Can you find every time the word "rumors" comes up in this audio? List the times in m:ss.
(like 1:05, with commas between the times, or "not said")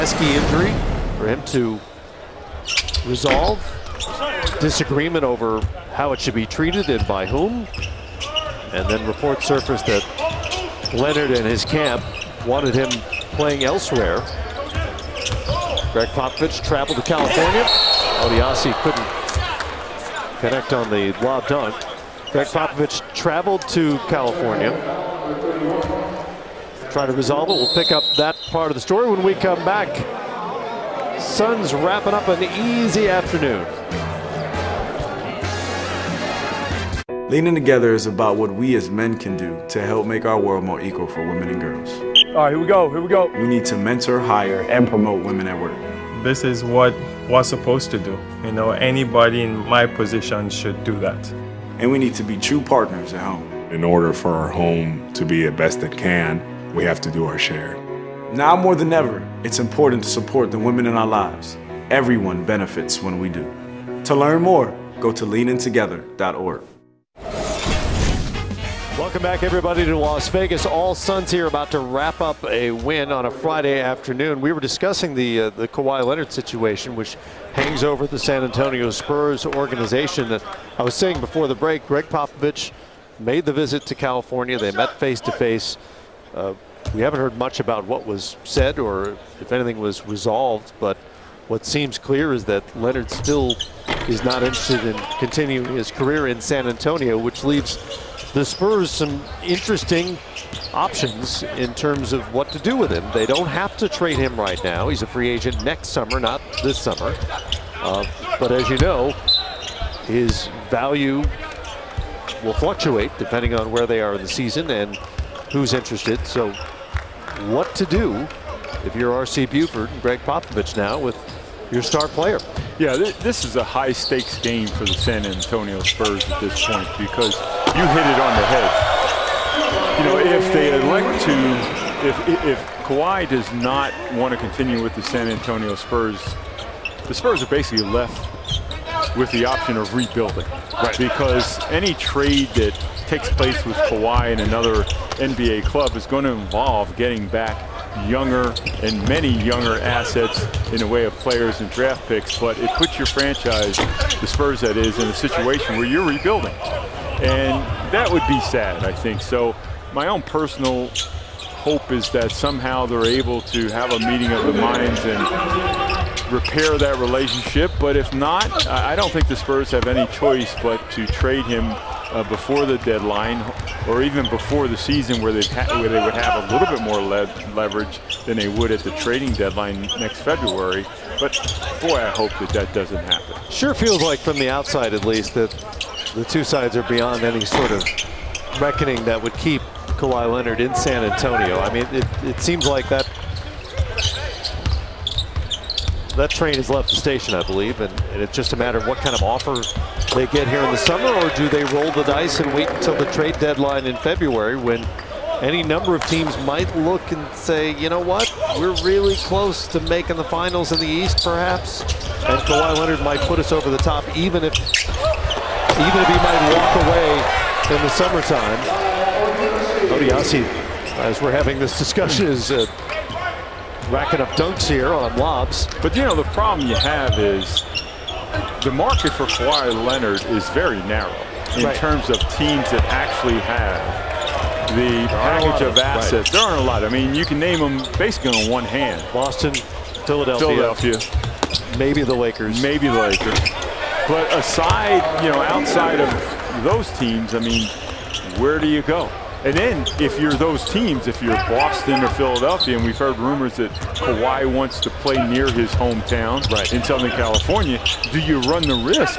4:13.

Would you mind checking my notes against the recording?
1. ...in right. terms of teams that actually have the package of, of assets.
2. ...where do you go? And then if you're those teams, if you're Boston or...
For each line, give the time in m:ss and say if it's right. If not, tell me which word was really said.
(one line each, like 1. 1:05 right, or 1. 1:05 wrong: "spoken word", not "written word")
1. 3:51 right
2. 4:08 right.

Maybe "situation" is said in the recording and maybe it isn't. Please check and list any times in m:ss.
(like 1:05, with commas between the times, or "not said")
1:16, 2:35.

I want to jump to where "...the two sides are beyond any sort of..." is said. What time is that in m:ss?
3:06.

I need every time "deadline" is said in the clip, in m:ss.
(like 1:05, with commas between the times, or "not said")
2:52, 2:59, 3:23.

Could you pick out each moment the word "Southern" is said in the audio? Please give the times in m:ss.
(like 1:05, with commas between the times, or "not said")
4:16.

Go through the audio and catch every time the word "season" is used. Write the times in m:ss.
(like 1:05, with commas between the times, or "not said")
1:54, 2:54.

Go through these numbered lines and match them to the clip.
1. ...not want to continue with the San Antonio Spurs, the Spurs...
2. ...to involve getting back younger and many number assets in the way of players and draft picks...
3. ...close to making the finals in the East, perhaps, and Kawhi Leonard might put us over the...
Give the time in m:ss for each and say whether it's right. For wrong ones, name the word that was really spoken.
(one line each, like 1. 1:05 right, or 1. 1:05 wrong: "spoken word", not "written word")
1. 2:13 right
2. 2:26 wrong: "younger", not "number"
3. 3:29 right.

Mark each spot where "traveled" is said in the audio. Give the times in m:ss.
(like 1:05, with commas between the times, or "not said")
0:16, 0:23.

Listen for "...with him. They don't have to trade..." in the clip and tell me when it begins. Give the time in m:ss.
1:42.